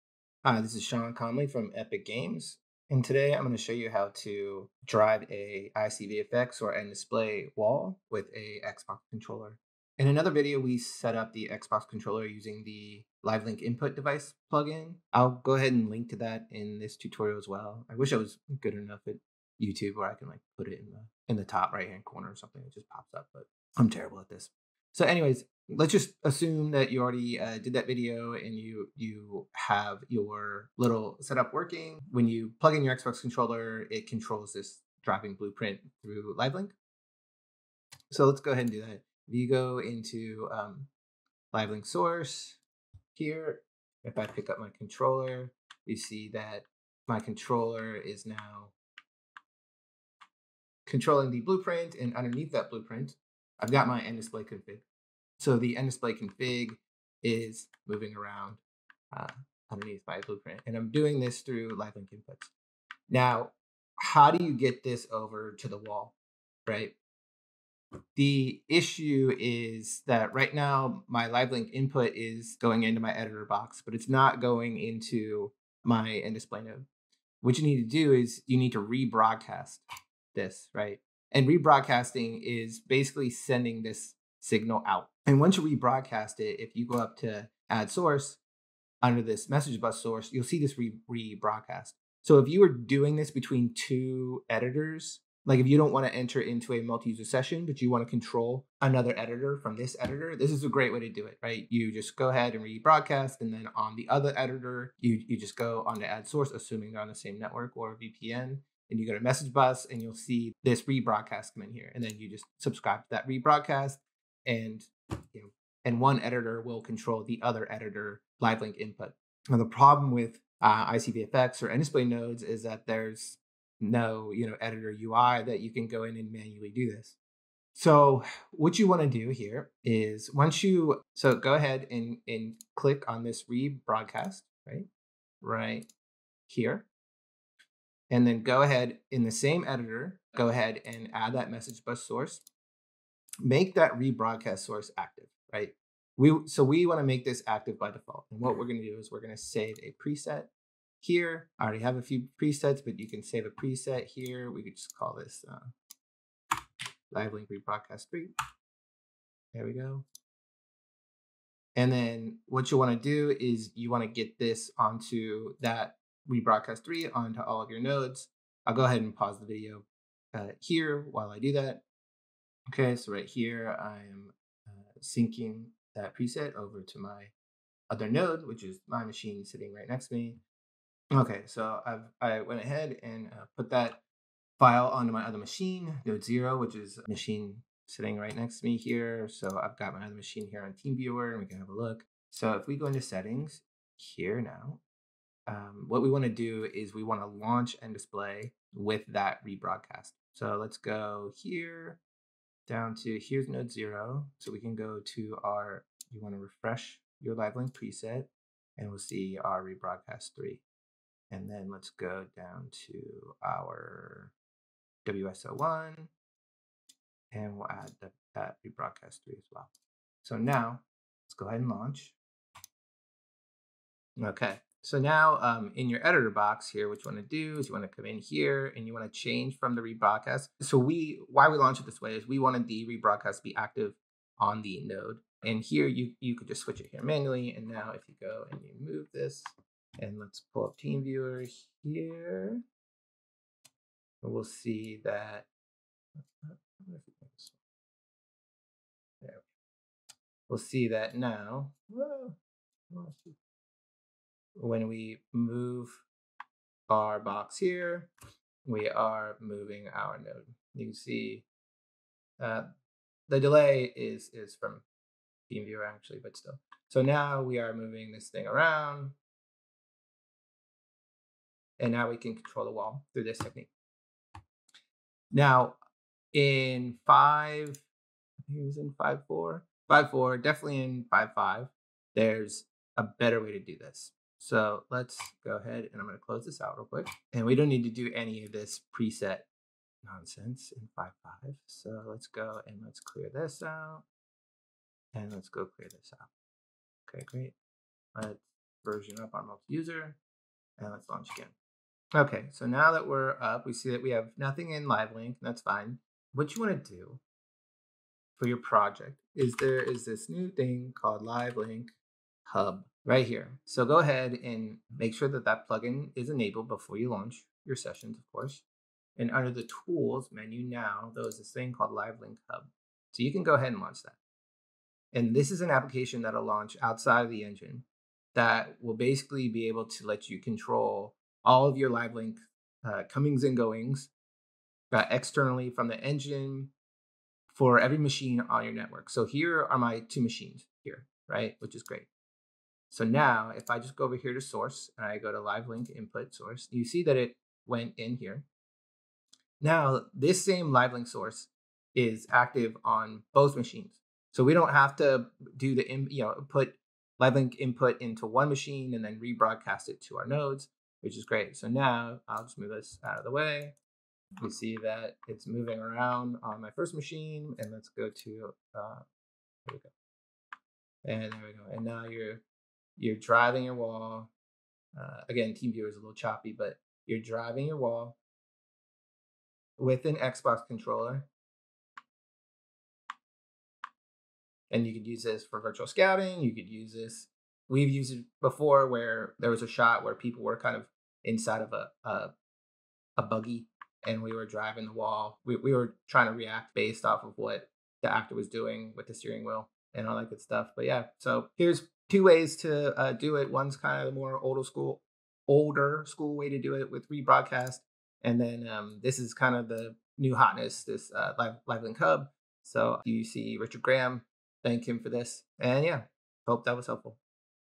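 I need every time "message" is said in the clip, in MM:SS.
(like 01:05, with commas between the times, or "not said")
01:29, 01:49, 02:21.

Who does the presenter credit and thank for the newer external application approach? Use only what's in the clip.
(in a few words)
Richard Graham.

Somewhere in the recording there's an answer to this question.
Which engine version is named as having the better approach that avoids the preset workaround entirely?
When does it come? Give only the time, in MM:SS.
04:50.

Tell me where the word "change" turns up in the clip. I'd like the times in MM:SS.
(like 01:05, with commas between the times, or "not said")
03:49.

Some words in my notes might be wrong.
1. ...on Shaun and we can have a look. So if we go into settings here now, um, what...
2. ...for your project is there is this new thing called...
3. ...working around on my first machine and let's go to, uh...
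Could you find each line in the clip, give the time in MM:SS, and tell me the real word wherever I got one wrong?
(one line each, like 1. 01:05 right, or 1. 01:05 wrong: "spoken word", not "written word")
1. 03:10 wrong: "TeamViewer", not "Shaun"
2. 05:08 right
3. 06:05 wrong: "moving", not "working".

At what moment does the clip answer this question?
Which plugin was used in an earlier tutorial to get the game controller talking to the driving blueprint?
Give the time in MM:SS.
00:13.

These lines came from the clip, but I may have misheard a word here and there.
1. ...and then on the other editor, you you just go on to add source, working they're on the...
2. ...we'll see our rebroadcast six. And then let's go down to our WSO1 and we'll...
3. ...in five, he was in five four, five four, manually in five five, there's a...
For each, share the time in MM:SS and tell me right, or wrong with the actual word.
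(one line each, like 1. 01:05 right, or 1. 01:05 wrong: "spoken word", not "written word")
1. 01:43 wrong: "assuming", not "working"
2. 03:28 wrong: "three", not "six"
3. 04:36 wrong: "definitely", not "manually".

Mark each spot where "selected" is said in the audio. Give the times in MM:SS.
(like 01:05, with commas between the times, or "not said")
not said.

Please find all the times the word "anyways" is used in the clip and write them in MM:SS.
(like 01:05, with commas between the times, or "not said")
00:25.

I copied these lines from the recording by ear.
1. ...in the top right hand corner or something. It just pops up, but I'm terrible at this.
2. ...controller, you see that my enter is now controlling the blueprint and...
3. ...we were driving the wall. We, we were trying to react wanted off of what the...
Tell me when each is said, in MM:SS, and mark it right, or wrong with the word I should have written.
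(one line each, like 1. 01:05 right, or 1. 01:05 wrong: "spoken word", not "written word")
1. 00:21 right
2. 00:44 wrong: "controller", not "enter"
3. 06:34 wrong: "based", not "wanted".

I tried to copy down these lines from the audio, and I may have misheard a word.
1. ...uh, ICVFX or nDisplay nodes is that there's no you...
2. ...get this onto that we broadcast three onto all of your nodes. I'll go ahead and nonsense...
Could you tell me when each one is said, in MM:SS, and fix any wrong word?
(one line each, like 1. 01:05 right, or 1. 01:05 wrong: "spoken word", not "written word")
1. 02:00 right
2. 02:44 wrong: "pause", not "nonsense".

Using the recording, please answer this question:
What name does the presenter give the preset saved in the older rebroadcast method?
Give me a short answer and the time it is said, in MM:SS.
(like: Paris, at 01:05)
live link rebroadcast three, at 02:37.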